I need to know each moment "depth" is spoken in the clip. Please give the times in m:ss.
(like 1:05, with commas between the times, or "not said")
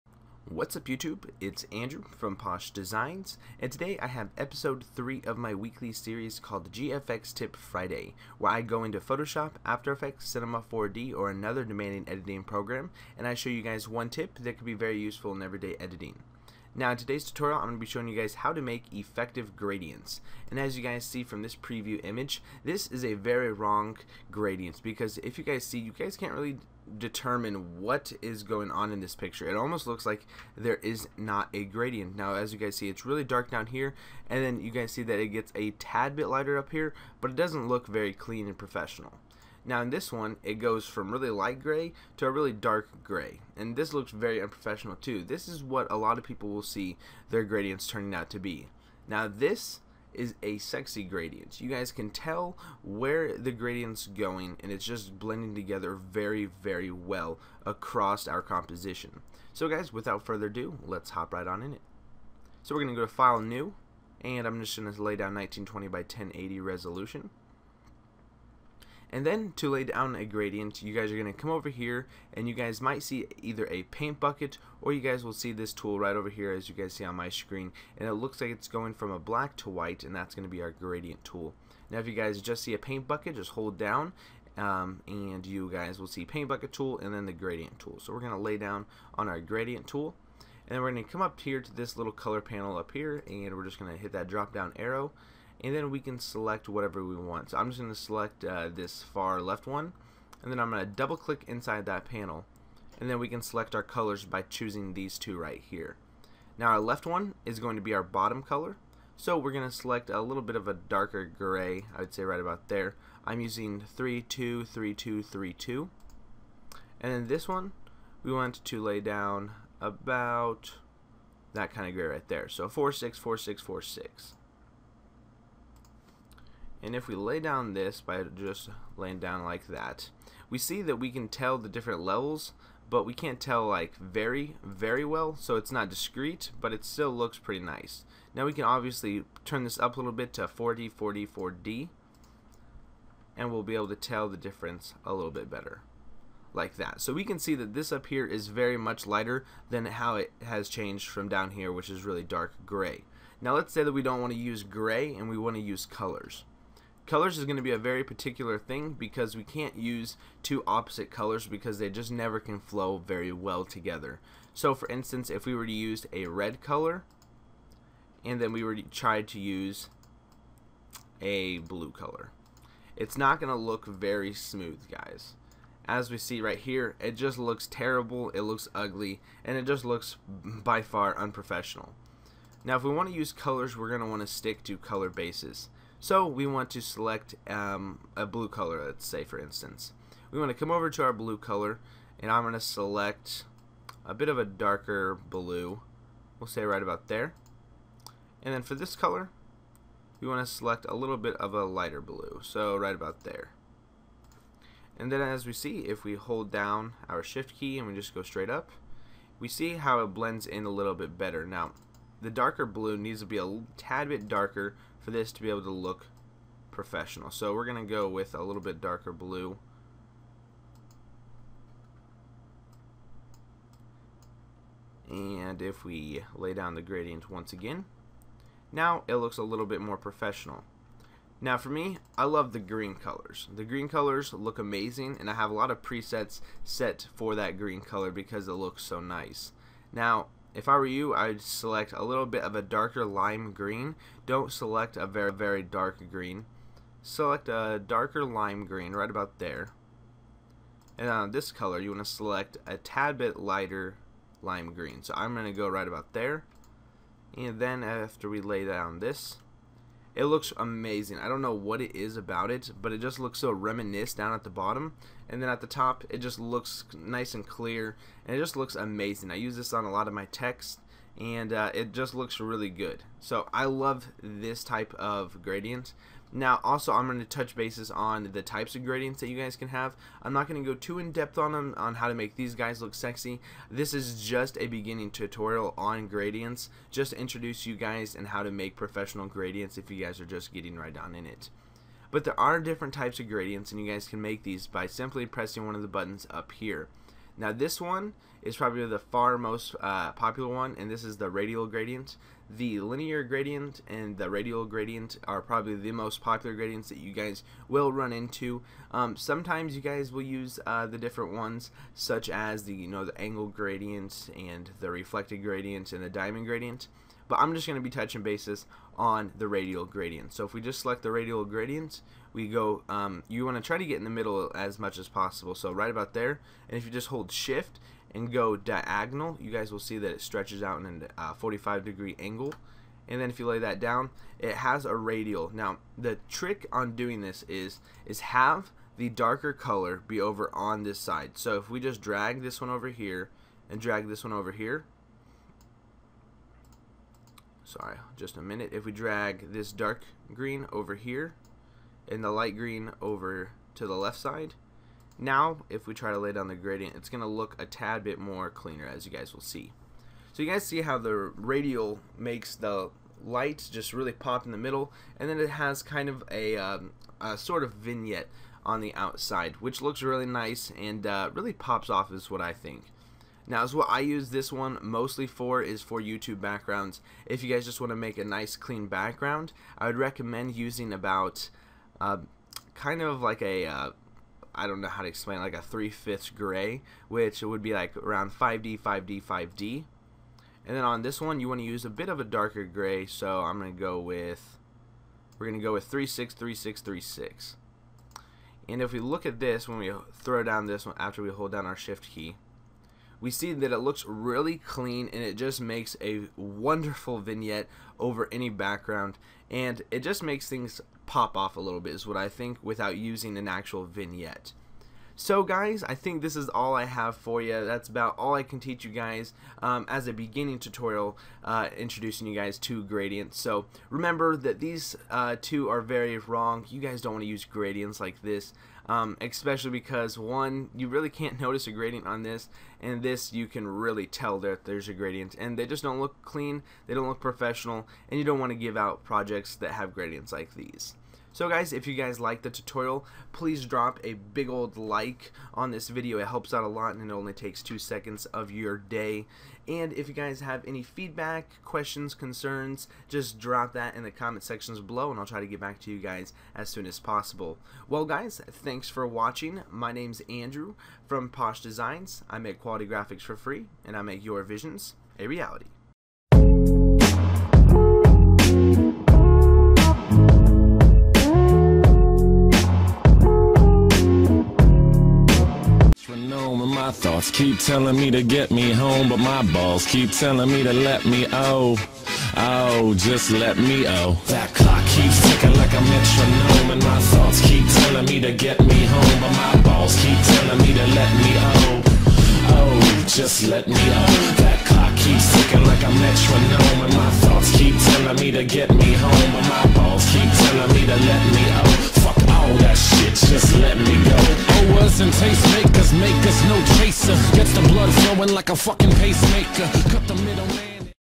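4:40.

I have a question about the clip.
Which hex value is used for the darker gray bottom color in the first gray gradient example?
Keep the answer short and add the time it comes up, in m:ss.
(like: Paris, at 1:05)
323232, at 1:53.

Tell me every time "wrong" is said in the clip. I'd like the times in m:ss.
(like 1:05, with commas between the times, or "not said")
0:23, 7:06.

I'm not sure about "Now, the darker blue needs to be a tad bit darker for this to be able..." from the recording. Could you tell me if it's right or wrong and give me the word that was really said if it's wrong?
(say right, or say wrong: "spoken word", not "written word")
right.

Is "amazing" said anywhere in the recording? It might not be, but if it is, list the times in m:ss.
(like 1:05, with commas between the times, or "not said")
3:54, 4:20, 4:28.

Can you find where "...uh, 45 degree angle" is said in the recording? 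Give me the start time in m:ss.
5:31.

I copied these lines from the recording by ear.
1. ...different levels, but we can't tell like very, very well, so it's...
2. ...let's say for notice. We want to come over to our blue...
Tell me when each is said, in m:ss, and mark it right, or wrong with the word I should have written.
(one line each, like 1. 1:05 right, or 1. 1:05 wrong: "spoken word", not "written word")
1. 2:11 right
2. 3:08 wrong: "instance", not "notice".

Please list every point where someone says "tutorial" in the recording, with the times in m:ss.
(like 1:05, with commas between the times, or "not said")
0:17, 4:45, 7:00, 7:22.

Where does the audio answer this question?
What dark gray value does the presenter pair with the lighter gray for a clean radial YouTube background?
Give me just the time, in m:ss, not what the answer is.
6:35.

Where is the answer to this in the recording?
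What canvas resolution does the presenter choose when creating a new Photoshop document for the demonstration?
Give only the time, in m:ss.
1:05.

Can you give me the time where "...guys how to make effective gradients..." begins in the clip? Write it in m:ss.
0:18.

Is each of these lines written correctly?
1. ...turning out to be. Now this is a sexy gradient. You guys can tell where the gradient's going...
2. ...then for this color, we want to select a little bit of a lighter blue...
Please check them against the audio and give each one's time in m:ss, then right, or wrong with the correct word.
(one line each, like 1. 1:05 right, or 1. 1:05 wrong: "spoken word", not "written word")
1. 0:47 right
2. 3:18 right.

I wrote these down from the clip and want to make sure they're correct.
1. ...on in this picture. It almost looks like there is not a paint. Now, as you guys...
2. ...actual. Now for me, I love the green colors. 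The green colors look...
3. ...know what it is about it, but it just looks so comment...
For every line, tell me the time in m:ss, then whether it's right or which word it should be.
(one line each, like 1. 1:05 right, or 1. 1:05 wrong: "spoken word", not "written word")
1. 0:28 wrong: "gradient", not "paint"
2. 3:49 wrong: "professional", not "actual"
3. 4:21 wrong: "reminiscent", not "comment".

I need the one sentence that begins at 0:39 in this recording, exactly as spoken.
Now in this one, it goes from really light gray to a really dark gray.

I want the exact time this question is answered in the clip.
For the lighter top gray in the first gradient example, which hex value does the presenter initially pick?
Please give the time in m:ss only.
2:02.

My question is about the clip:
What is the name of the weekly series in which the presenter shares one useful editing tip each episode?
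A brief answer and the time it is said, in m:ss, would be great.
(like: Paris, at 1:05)
GFX Tip Friday, at 0:06.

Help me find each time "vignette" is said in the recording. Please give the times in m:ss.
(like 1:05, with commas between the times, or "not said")
6:07, 6:47, 6:53.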